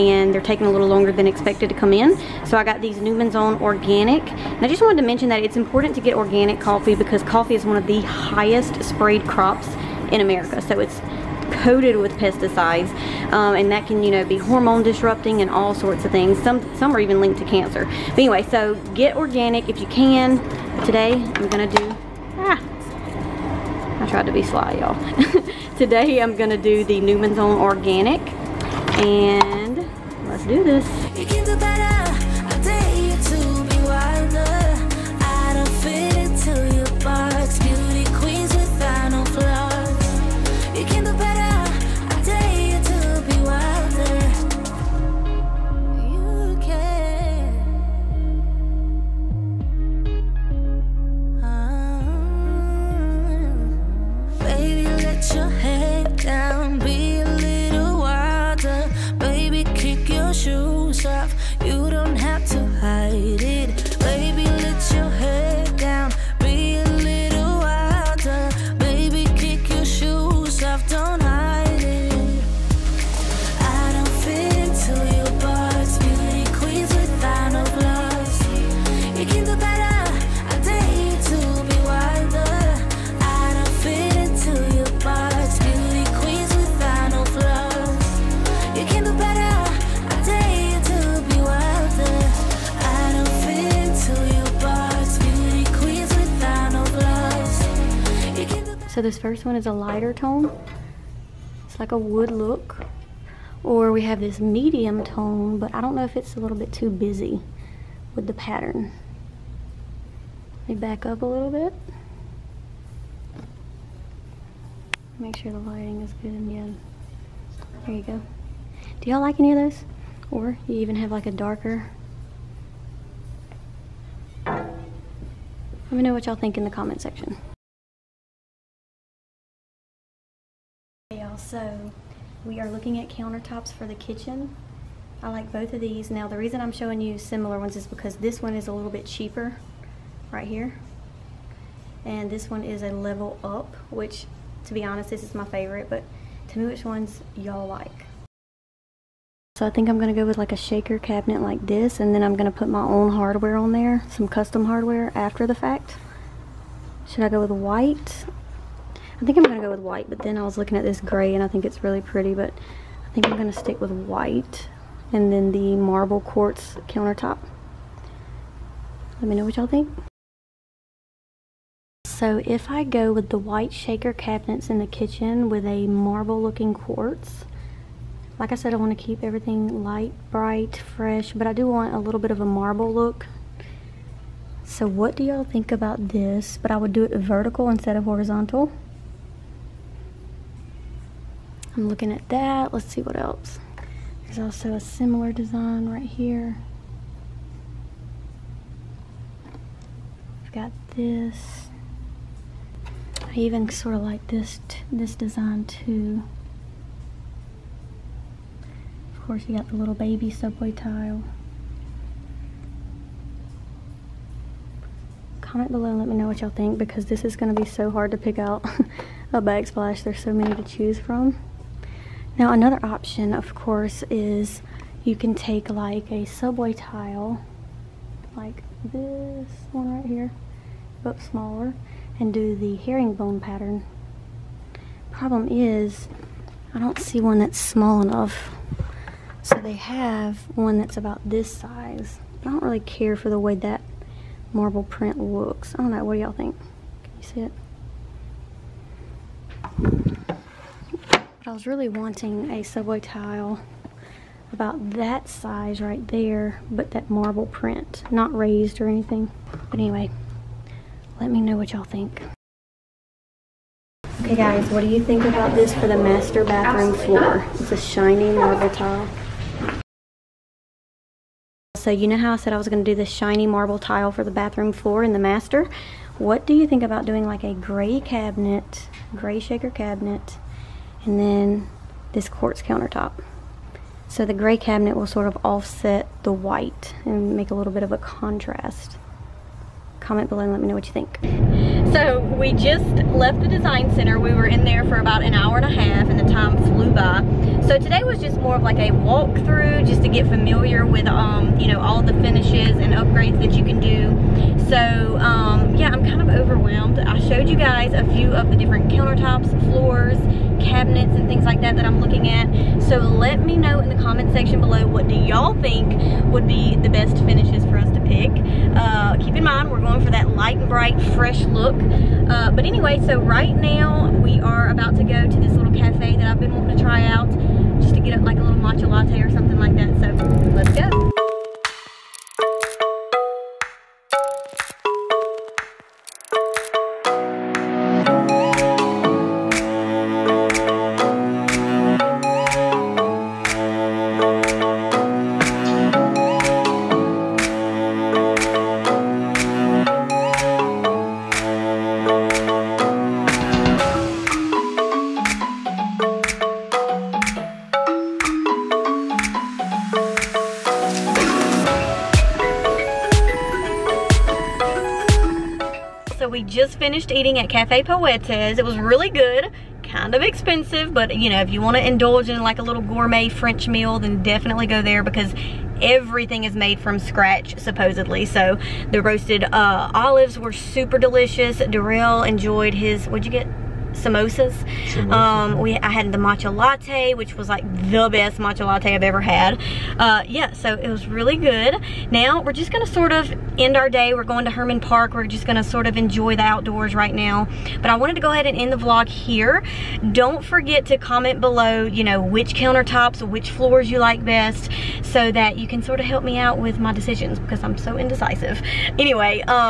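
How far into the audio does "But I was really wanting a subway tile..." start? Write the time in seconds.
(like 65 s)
251 s.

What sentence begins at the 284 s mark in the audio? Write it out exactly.
So the gray cabinet will sort of offset the white and make a little bit of a contrast.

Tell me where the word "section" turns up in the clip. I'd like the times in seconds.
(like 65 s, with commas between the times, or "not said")
126 s, 314 s.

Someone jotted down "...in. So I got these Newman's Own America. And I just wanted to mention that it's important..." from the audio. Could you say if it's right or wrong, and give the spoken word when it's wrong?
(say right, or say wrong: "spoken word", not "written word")
wrong: "Organic", not "America".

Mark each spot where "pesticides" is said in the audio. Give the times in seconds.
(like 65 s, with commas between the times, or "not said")
12 s.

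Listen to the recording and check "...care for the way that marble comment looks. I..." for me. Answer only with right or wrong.
wrong.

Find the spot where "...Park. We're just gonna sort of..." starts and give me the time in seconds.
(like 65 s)
394 s.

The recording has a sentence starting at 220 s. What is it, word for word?
There's so many to choose from.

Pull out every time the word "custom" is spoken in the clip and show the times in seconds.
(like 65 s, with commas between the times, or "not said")
154 s.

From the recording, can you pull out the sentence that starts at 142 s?
And this one is a level up, which to be honest, this is my favorite, but tell me which ones y'all like.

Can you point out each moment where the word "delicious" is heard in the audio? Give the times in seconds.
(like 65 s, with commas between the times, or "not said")
380 s.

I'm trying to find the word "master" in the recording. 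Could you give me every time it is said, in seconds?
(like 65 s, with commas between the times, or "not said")
265 s, 275 s.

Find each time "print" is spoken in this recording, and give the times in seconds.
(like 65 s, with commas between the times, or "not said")
244 s, 257 s.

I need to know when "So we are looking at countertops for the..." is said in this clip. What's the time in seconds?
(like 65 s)
131 s.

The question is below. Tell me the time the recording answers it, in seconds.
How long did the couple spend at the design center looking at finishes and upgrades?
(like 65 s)
294 s.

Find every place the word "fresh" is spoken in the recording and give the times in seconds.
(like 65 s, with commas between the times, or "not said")
180 s, 321 s.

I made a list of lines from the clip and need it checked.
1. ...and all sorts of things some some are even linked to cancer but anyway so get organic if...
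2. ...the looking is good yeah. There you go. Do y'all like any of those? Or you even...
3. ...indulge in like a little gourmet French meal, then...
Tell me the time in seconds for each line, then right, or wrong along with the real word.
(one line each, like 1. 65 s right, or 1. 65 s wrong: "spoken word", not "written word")
1. 15 s right
2. 115 s wrong: "lighting", not "looking"
3. 371 s right.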